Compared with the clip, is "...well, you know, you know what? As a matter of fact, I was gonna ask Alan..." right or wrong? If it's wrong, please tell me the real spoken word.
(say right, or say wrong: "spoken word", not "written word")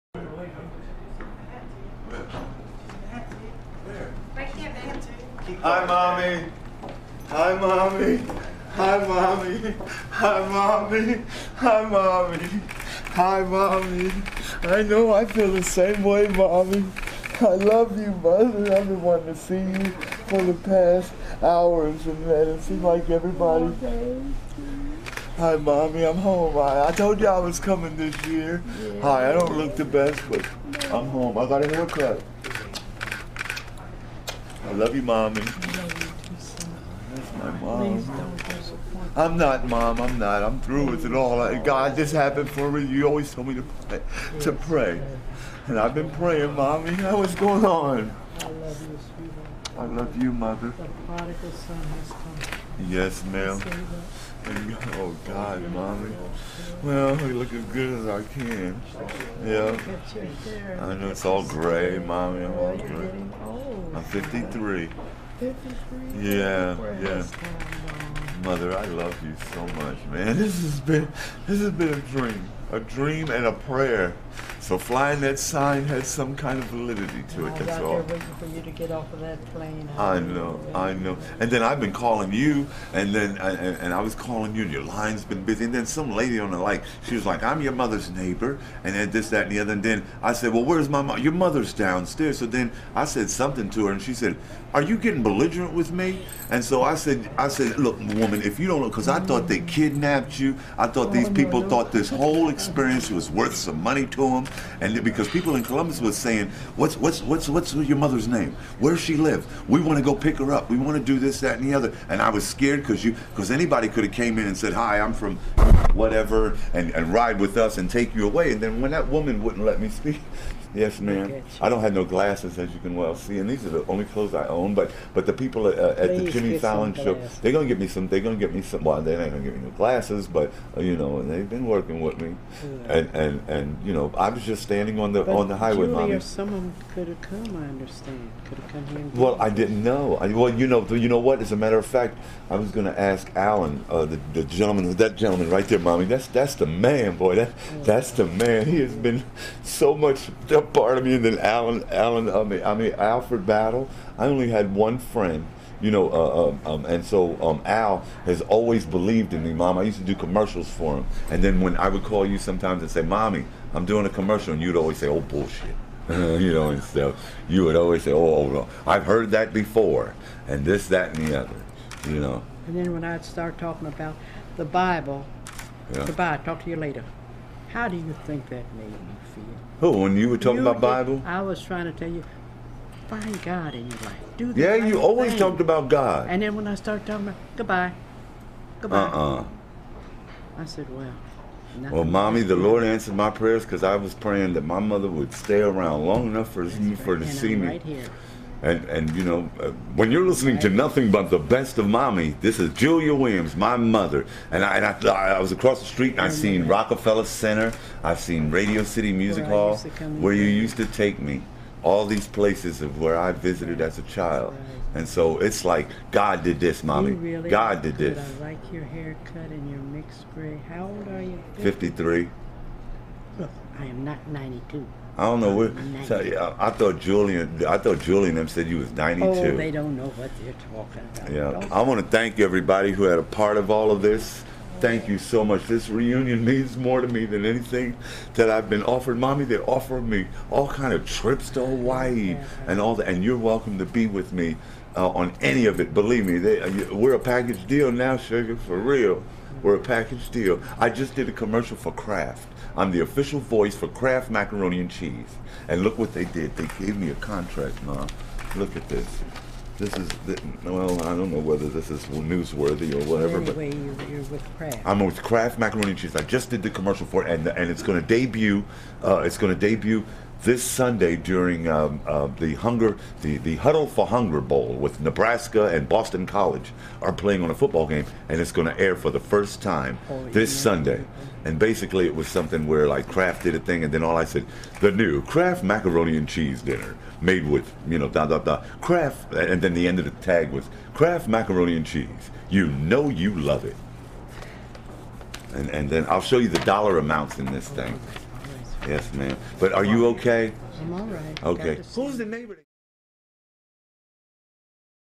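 right.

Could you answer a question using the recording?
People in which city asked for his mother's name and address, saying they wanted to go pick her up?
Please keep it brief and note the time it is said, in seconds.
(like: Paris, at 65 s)
Columbus, at 105 s.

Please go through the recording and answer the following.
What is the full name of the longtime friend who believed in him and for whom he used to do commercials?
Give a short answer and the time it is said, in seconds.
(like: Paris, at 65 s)
Alfred Battle, at 152 s.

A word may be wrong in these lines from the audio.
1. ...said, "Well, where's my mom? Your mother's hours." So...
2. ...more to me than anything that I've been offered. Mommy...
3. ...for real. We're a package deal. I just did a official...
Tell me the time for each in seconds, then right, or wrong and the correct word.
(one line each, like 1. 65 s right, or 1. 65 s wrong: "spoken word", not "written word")
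1. 90 s wrong: "downstairs", not "hours"
2. 236 s right
3. 248 s wrong: "commercial", not "official".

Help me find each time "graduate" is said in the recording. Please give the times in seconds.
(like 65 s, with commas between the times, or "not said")
not said.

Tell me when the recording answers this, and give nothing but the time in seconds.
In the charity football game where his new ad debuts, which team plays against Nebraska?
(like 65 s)
275 s.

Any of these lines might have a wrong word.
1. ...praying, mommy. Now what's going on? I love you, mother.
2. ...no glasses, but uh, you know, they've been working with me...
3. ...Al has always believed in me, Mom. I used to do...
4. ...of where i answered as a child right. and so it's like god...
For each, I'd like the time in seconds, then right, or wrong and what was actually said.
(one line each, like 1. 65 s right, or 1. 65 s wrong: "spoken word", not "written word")
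1. 46 s right
2. 129 s right
3. 157 s right
4. 212 s wrong: "visited", not "answered".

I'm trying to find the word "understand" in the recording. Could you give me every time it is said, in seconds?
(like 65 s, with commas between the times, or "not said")
137 s.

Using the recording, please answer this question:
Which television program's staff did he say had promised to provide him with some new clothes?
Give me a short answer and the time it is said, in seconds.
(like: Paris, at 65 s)
Jimmy Fallon show, at 126 s.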